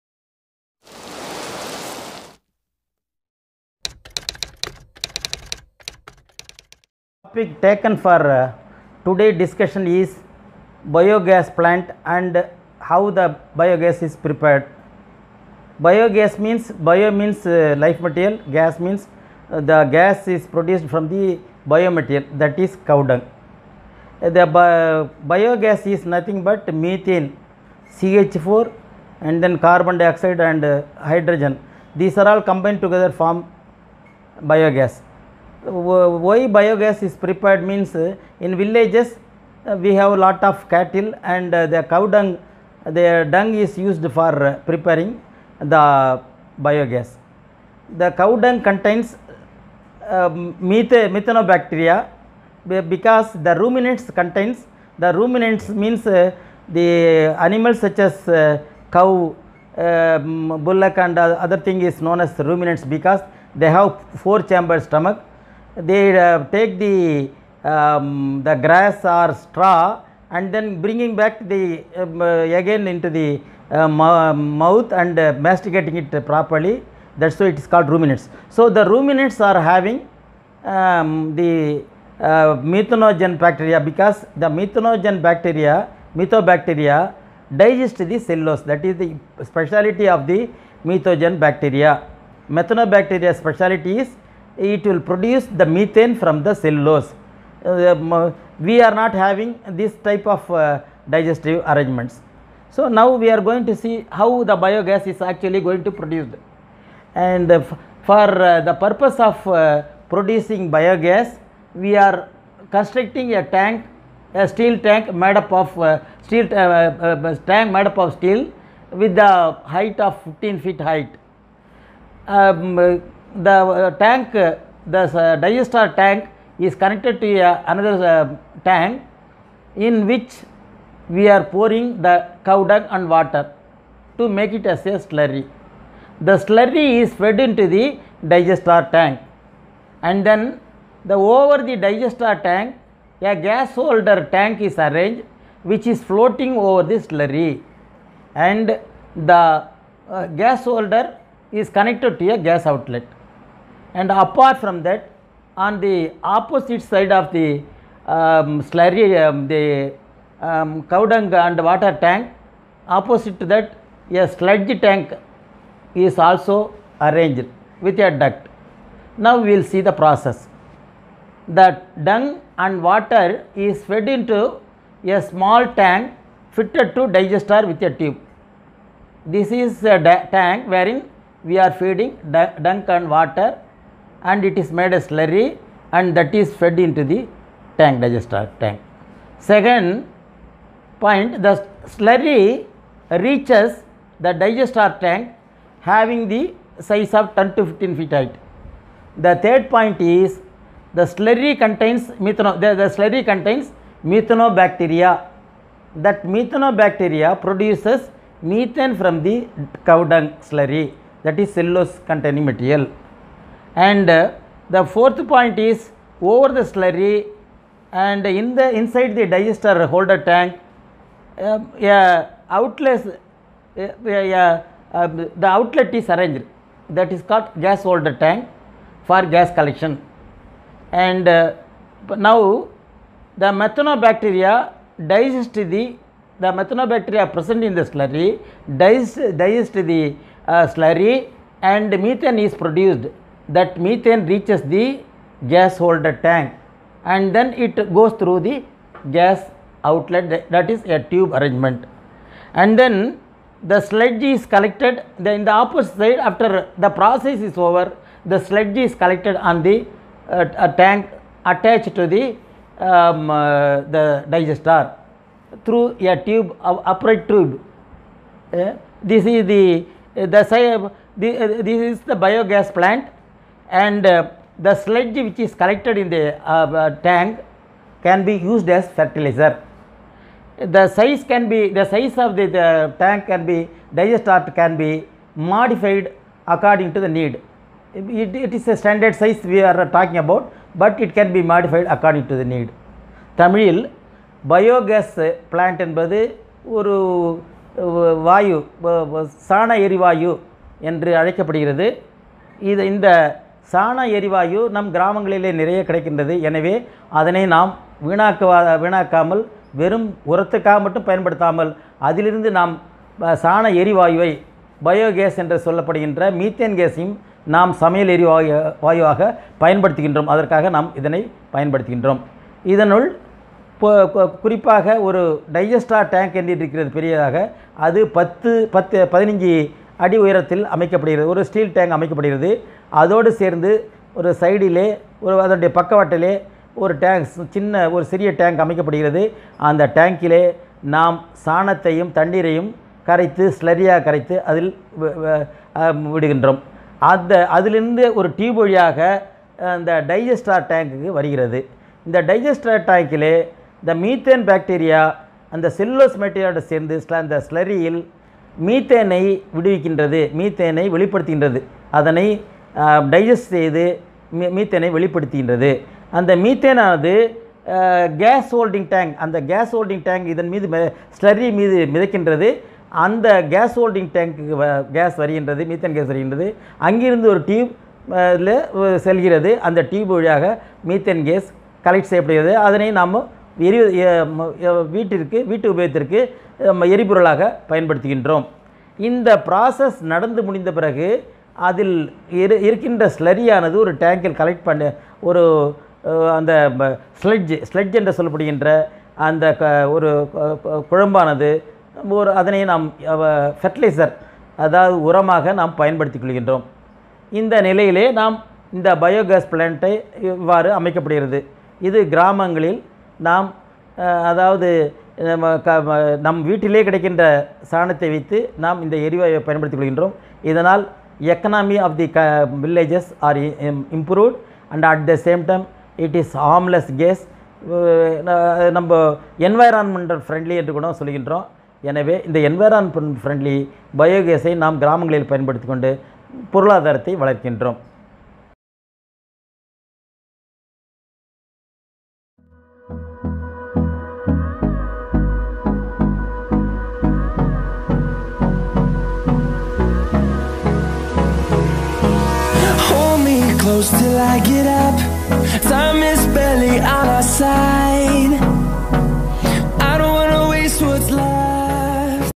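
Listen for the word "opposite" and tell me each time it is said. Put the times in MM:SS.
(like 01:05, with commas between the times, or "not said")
02:36, 02:42, 04:15.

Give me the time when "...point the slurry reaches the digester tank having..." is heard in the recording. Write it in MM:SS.
03:11.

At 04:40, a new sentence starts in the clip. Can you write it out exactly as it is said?
The size can be the size of the, the tank can be digestat can be modified according to the need.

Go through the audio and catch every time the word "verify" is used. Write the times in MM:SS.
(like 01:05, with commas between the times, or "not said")
not said.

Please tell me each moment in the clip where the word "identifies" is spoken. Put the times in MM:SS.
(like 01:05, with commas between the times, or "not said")
not said.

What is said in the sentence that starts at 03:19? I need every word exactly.
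The third point is the slurry contains methano, the, the slurry contains methanobacteria.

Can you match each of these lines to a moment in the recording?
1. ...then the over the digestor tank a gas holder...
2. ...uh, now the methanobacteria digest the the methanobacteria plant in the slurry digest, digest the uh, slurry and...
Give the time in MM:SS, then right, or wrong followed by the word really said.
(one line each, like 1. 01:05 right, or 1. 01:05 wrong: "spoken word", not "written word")
1. 02:20 right
2. 03:51 wrong: "present", not "plant".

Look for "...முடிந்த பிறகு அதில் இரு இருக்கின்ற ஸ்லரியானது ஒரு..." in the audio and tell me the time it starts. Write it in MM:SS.
06:30.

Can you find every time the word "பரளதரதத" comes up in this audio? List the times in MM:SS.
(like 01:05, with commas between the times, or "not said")
07:16.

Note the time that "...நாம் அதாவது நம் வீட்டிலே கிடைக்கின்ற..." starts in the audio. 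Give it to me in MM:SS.
06:53.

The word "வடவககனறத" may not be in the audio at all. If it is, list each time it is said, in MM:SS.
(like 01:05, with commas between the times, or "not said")
05:59.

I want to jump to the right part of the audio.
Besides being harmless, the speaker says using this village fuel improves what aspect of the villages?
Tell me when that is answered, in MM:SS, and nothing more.
07:01.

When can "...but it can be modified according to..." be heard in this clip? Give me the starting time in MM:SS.
04:50.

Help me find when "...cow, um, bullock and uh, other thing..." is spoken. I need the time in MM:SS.
00:58.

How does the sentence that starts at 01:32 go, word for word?
Methanobacteria speciality is it will produce the methane from the cellulose.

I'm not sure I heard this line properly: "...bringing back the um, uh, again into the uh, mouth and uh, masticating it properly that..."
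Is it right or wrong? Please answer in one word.
right.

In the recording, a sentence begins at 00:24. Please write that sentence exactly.
The bi biogas is nothing but methane, CH4 and then carbon dioxide and uh, hydrogen.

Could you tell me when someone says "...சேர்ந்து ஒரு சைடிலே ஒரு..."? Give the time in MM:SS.
05:33.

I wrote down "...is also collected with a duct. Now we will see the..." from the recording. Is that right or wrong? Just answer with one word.
wrong.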